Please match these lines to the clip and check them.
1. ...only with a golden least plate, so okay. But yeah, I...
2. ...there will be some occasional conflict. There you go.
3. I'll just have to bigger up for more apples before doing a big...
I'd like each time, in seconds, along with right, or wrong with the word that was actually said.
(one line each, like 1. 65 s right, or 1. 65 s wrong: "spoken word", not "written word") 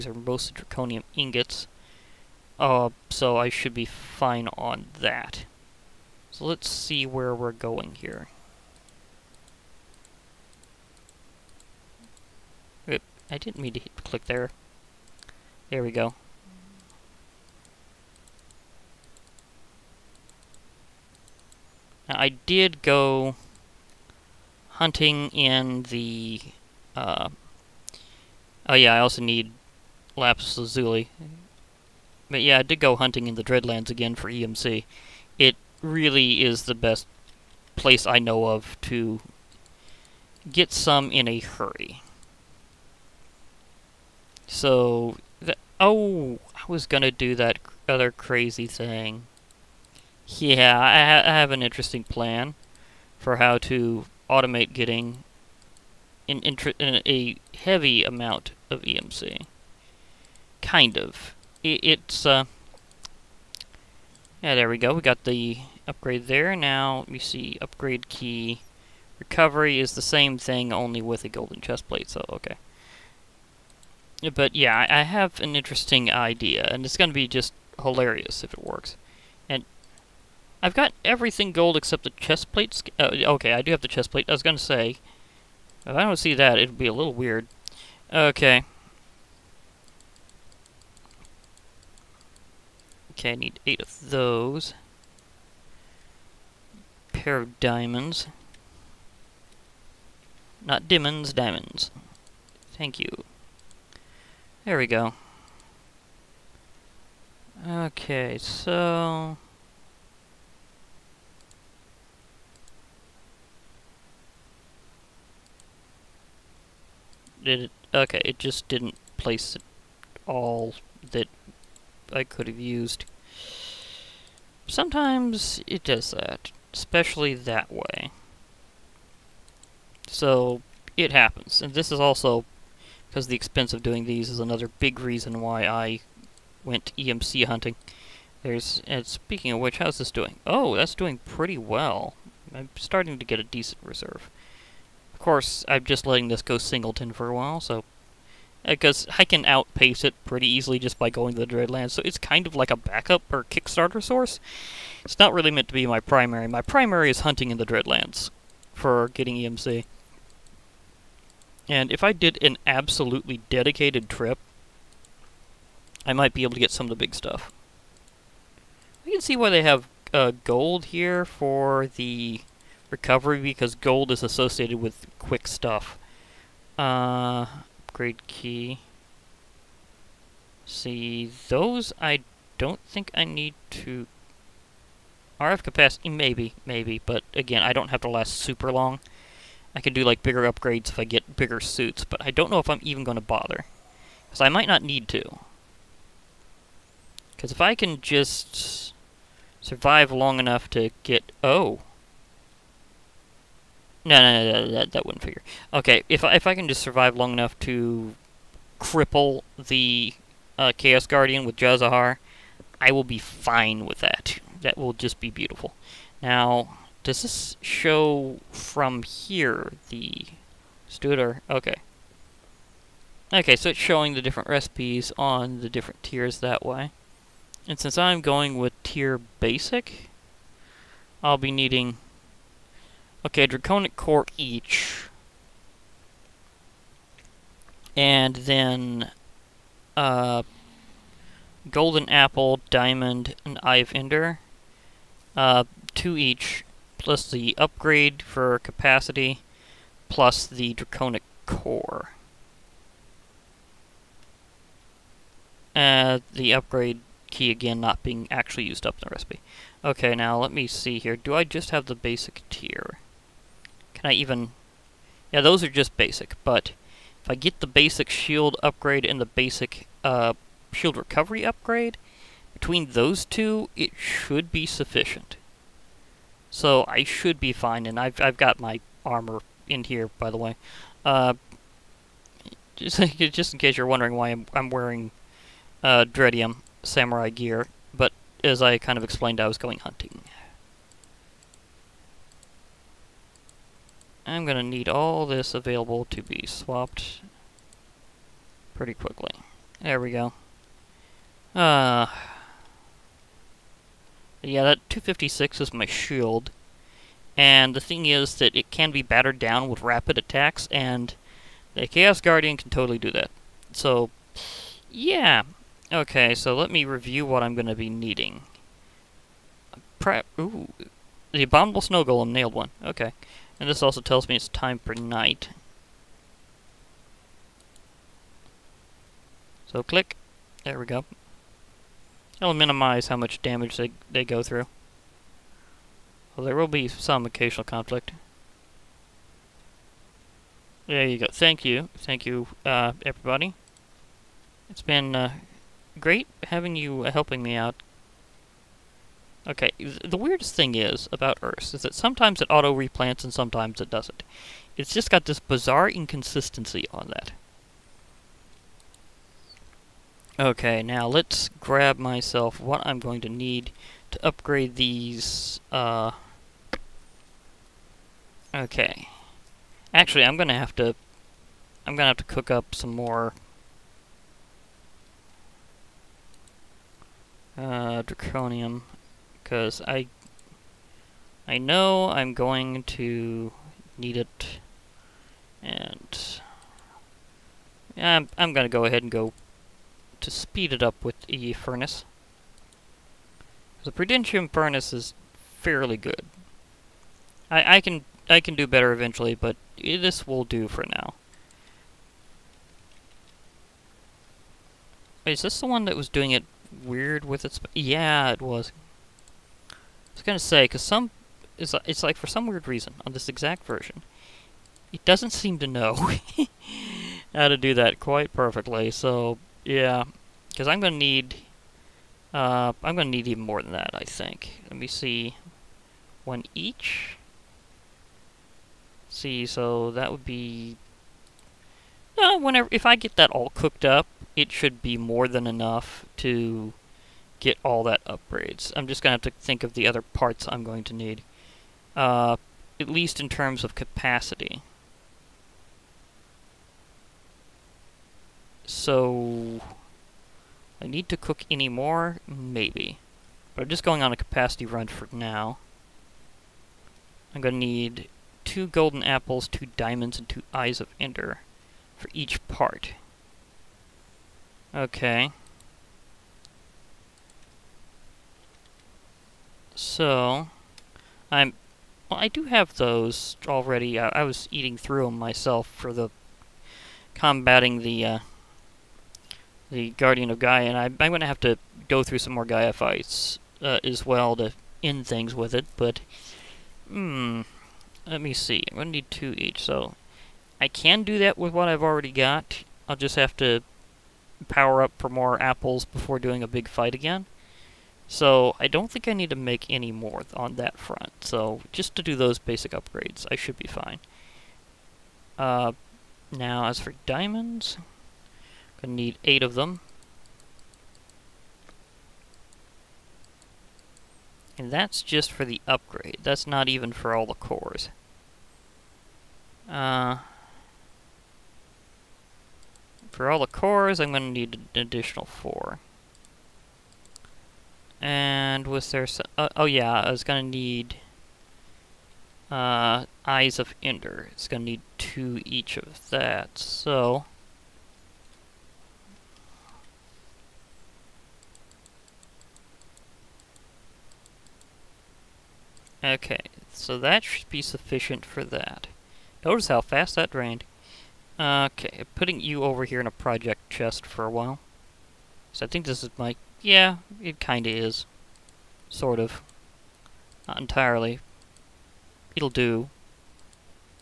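1. 70 s wrong: "chest", not "least"
2. 336 s right
3. 492 s wrong: "power", not "bigger".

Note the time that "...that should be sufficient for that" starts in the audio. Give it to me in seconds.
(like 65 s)
546 s.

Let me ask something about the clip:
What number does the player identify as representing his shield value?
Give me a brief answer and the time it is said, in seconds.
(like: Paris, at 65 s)
256, at 304 s.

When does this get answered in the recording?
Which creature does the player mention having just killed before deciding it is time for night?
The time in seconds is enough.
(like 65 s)
321 s.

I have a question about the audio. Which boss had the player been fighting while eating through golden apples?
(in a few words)
Guardian of Gaia.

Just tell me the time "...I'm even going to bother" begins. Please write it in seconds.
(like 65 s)
192 s.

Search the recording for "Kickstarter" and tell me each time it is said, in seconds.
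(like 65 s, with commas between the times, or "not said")
153 s.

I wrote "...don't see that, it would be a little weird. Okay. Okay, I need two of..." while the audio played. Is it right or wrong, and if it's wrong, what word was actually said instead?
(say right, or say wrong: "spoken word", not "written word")
wrong: "eight", not "two".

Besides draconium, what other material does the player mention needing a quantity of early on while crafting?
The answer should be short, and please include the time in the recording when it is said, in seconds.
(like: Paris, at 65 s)
Lapis Lazuli, at 30 s.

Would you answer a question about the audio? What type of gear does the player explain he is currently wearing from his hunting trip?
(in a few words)
Dreadium samurai gear.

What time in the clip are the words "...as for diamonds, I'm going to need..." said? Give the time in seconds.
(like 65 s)
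506 s.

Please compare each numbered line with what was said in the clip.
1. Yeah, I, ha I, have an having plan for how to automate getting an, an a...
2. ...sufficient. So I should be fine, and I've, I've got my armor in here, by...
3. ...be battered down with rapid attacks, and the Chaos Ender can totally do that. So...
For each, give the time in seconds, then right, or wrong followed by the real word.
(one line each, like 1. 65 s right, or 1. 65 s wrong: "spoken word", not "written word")
1. 50 s wrong: "interesting", not "having"
2. 274 s right
3. 308 s wrong: "Guardian", not "Ender".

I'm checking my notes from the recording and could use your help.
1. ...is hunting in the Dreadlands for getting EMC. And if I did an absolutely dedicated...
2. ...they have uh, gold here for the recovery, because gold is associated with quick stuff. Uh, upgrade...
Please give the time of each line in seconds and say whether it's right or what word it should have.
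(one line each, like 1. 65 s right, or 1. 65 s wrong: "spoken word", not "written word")
1. 157 s right
2. 169 s right.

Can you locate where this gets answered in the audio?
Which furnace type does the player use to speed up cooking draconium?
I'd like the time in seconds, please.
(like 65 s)
393 s.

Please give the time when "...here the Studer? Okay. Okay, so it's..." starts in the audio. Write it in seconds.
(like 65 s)
219 s.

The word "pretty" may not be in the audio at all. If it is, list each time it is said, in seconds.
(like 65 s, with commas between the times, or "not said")
141 s, 150 s, 298 s.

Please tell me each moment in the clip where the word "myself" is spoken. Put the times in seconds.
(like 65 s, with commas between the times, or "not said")
361 s, 475 s.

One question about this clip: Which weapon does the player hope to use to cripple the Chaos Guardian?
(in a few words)
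J'zahar.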